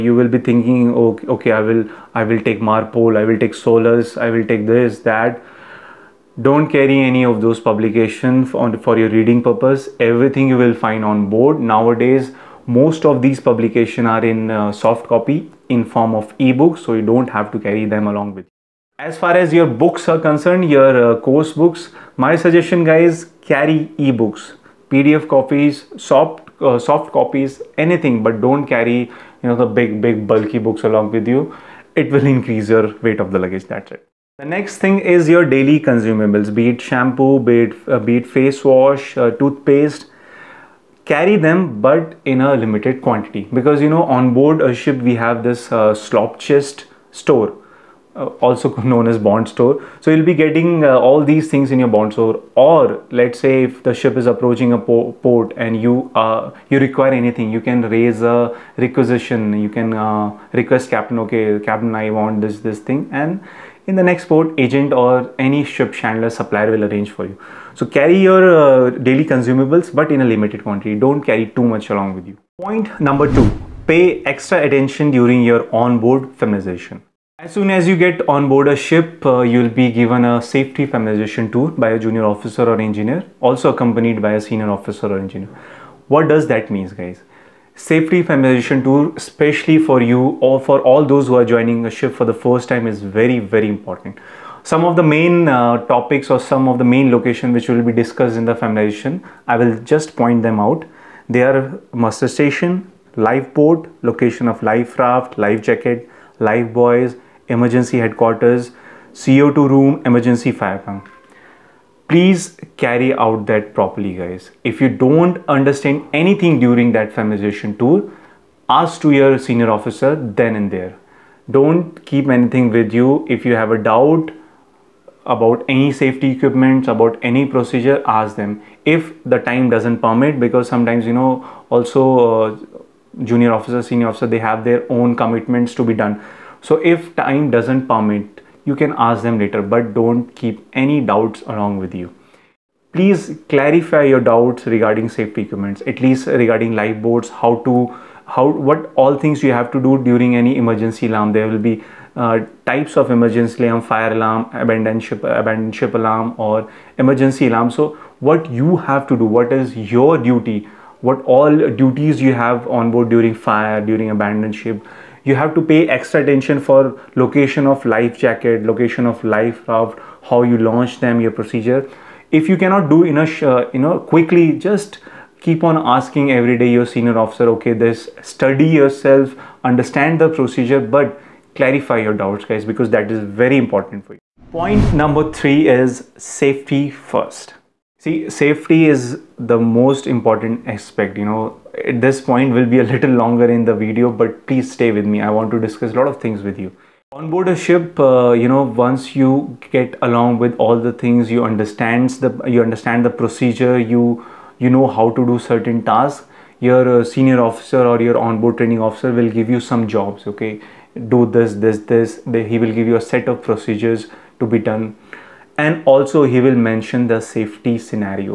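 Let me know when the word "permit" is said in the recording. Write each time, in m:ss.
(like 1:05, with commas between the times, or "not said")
2:09, 2:17.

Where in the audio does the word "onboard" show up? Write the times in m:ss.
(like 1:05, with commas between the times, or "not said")
1:15, 3:28.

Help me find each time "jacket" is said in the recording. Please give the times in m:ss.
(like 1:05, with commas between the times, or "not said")
1:45, 2:48.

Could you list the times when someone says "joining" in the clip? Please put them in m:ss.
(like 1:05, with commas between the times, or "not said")
1:31.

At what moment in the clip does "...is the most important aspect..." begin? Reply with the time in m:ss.
3:08.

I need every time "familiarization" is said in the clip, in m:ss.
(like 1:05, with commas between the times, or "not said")
1:16, 1:20, 1:28, 1:38, 1:57.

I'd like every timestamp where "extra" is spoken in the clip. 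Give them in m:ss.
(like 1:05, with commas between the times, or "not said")
1:14, 2:45.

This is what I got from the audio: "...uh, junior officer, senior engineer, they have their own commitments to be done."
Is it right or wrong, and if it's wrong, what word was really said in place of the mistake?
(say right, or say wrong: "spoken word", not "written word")
wrong: "officer", not "engineer".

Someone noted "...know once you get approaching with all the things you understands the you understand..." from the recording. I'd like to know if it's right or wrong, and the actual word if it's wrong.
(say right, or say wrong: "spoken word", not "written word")
wrong: "along", not "approaching".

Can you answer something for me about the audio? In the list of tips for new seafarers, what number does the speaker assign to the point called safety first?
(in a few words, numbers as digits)
3.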